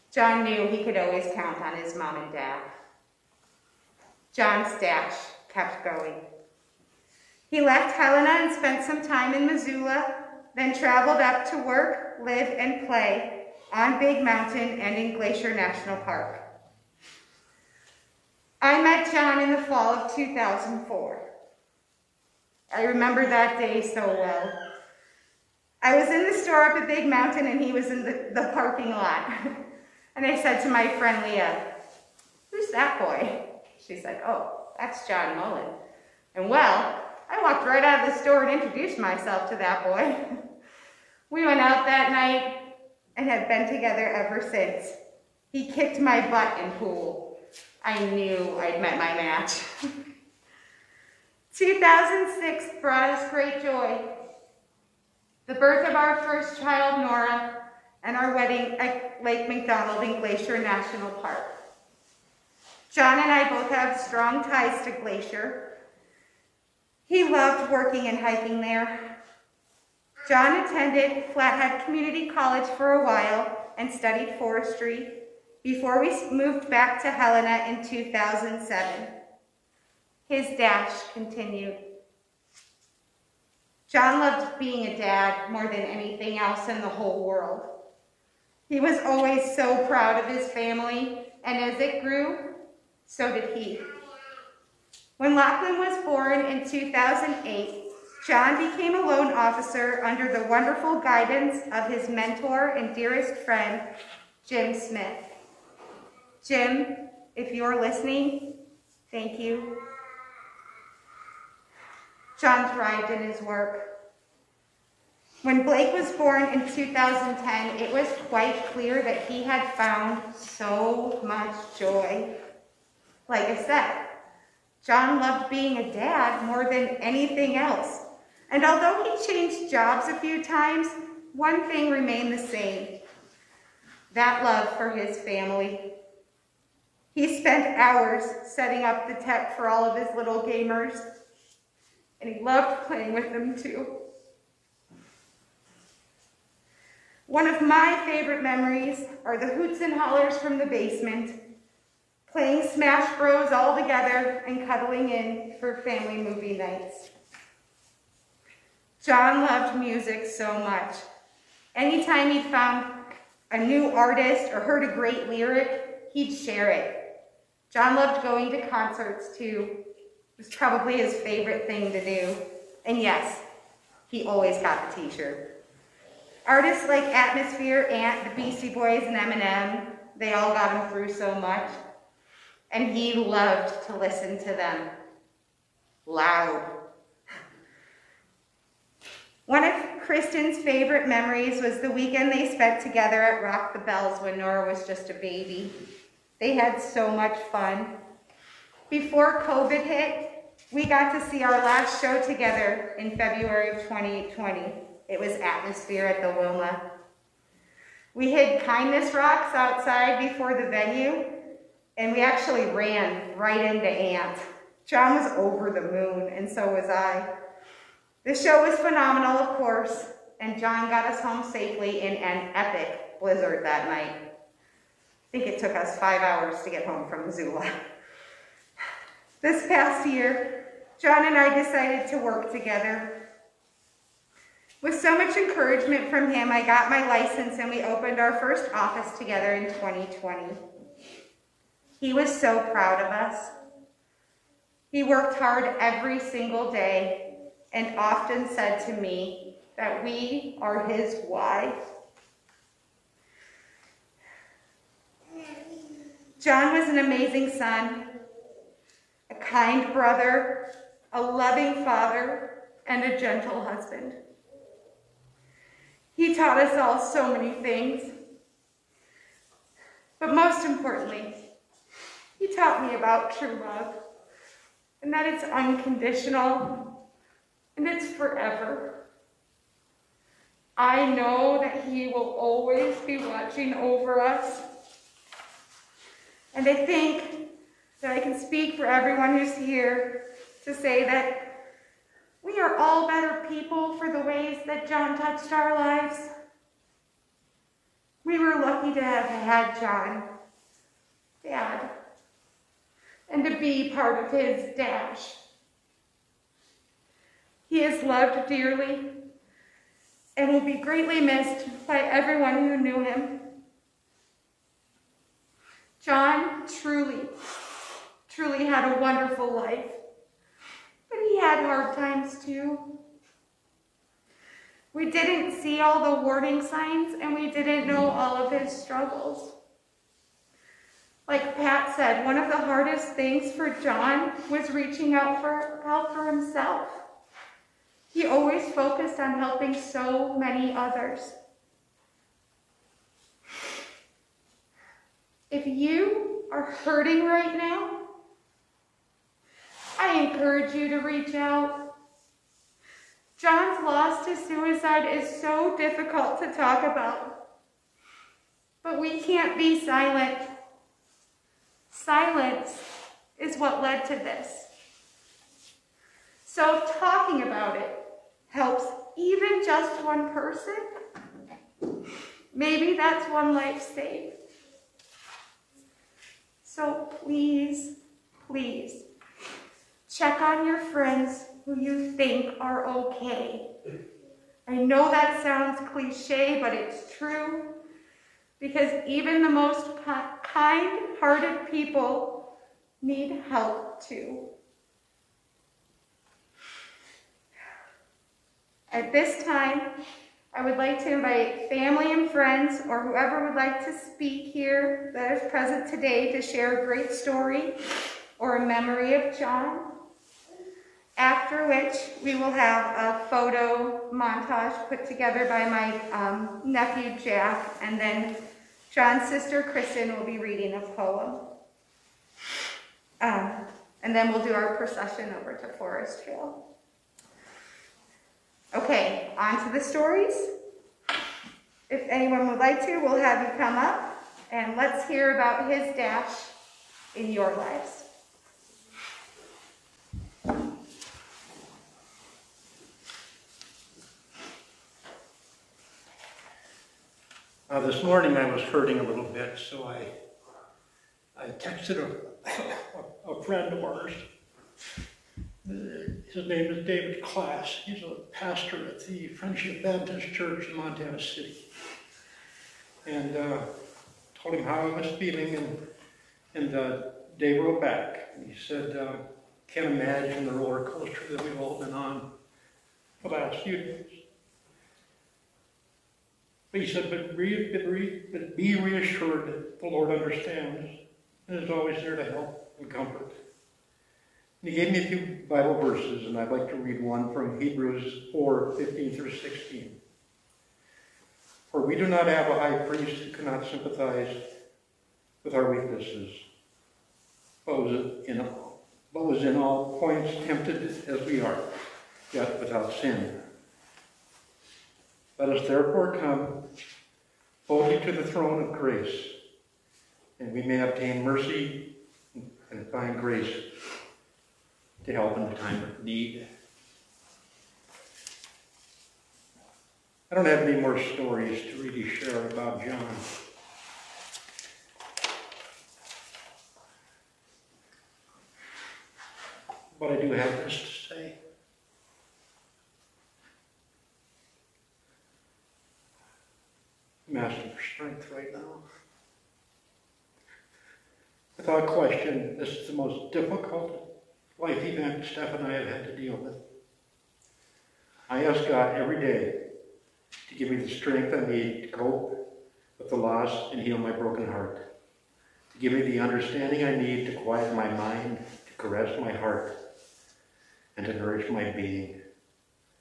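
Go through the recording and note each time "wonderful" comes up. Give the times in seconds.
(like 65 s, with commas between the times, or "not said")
100 s, 318 s.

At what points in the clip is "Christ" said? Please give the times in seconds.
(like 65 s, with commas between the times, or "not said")
not said.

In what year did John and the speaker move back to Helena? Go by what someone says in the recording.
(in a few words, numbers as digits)
2007.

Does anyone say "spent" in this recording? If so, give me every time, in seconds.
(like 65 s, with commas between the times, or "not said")
8 s, 137 s, 192 s.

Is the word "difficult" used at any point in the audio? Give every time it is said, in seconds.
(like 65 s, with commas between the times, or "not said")
355 s, 543 s.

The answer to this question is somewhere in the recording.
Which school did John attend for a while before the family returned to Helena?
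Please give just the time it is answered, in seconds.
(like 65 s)
71 s.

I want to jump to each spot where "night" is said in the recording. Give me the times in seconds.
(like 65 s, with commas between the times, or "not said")
42 s, 156 s, 223 s.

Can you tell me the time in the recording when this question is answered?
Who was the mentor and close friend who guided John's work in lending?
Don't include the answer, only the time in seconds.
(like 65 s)
104 s.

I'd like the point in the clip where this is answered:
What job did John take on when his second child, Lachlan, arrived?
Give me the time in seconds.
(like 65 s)
99 s.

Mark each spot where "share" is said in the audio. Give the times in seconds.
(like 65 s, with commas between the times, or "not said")
166 s, 406 s, 522 s.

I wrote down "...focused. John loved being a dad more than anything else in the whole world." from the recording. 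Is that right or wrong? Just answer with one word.
wrong.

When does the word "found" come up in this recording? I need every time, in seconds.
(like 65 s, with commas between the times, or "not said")
119 s, 162 s.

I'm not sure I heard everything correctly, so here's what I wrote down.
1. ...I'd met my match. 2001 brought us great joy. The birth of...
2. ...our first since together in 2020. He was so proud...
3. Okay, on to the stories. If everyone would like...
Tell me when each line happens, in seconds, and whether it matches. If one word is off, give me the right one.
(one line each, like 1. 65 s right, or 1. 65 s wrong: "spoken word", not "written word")
1. 48 s wrong: "2006", not "2001"
2. 238 s wrong: "office", not "since"
3. 428 s wrong: "anyone", not "everyone".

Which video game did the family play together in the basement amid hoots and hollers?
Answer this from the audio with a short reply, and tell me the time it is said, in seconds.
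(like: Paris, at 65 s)
Smash Bros, at 152 s.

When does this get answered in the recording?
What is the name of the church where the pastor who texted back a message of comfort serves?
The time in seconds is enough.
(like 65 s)
459 s.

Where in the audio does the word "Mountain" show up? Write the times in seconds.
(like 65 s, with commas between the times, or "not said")
14 s, 27 s.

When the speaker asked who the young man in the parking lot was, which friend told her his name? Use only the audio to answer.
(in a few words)
Leah.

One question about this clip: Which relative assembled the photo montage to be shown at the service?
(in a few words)
Jack.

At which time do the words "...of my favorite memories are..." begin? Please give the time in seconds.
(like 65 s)
147 s.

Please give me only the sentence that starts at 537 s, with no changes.
I'm asking for strength right now.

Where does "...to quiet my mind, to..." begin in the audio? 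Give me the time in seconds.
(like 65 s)
557 s.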